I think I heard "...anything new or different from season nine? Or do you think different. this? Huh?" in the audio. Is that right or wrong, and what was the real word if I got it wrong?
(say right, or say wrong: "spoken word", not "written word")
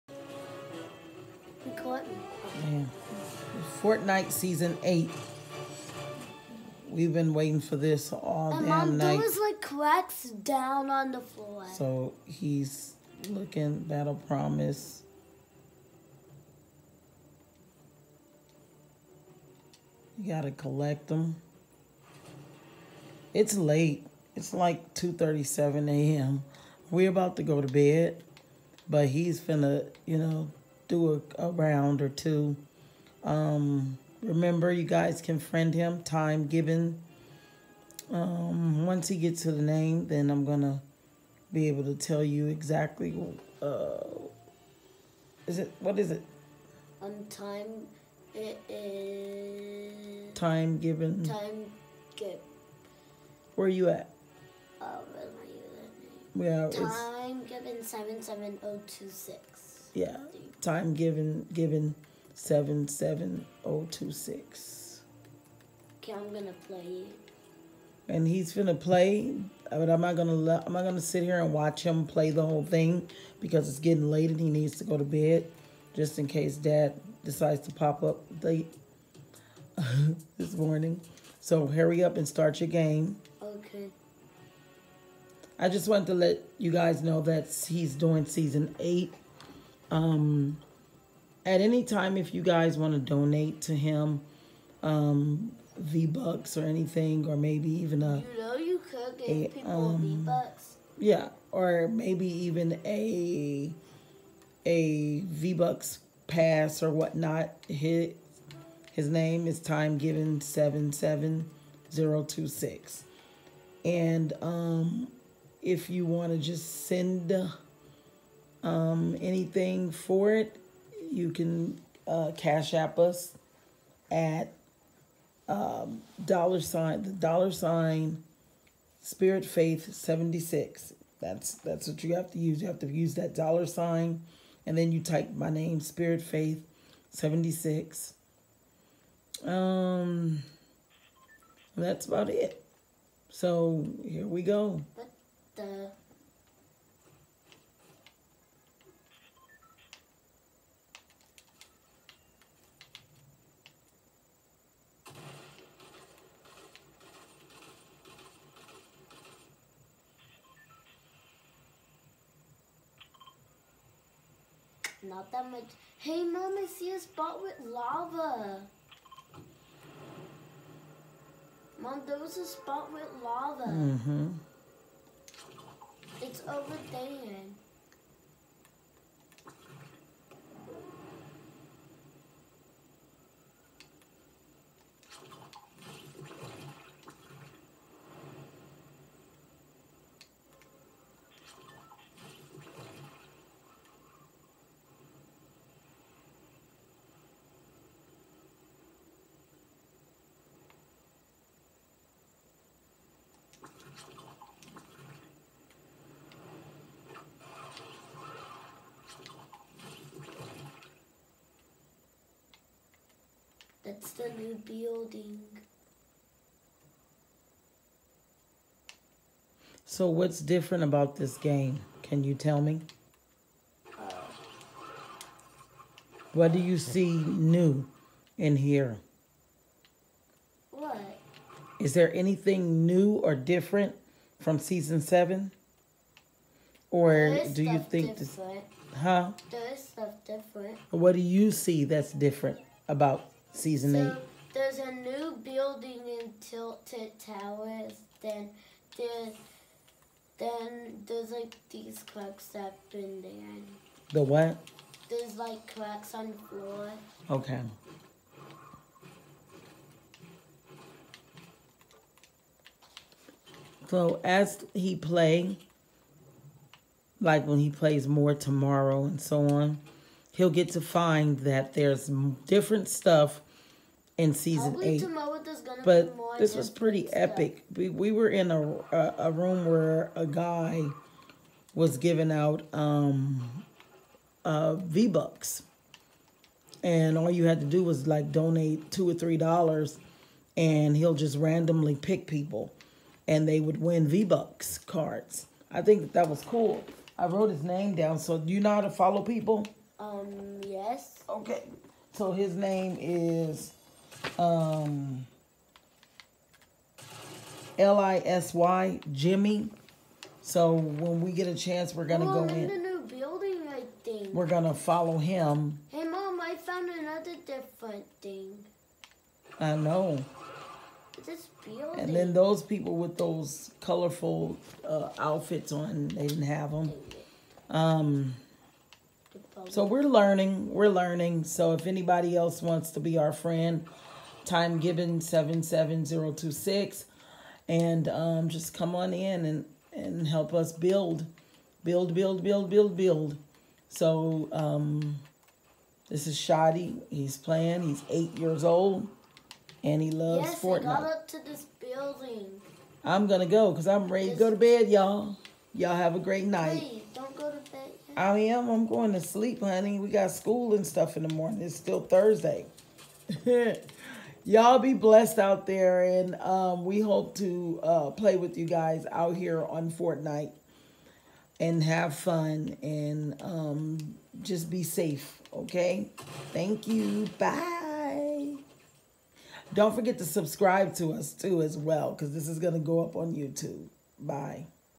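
wrong: "seven", not "nine".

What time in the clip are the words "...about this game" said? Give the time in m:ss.
3:40.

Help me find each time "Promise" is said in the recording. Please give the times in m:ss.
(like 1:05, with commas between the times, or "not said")
0:14.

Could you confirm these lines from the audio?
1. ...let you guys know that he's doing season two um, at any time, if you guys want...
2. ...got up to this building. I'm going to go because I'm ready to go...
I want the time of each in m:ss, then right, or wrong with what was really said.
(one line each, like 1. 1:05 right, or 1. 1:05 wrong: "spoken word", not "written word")
1. 1:26 wrong: "eight", not "two"
2. 5:51 right.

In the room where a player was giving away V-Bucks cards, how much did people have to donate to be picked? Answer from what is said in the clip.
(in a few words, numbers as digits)
2 or 3 dollars.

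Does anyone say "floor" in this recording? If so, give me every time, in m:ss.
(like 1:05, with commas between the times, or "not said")
0:11, 4:16.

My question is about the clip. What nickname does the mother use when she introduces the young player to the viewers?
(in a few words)
Shotty.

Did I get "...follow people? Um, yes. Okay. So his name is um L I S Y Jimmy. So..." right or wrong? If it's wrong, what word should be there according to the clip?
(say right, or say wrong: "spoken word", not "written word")
right.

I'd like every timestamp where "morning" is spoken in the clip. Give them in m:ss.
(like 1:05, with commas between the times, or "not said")
1:20, 6:01.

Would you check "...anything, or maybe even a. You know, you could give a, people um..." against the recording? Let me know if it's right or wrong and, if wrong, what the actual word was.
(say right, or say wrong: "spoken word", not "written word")
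right.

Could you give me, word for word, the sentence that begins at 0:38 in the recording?
Um, once he gets to the name, then I'm going to be able to tell you exactly.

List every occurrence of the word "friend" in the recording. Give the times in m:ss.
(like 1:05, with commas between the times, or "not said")
0:35, 5:33.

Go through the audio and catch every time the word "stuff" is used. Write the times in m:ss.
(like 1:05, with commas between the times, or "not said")
3:59, 4:32, 4:37, 6:00.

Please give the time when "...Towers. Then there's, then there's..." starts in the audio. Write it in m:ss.
4:07.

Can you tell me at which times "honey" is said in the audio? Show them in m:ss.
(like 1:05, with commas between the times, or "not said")
5:59.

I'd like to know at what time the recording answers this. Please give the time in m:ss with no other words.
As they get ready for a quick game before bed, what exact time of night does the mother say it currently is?
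0:24.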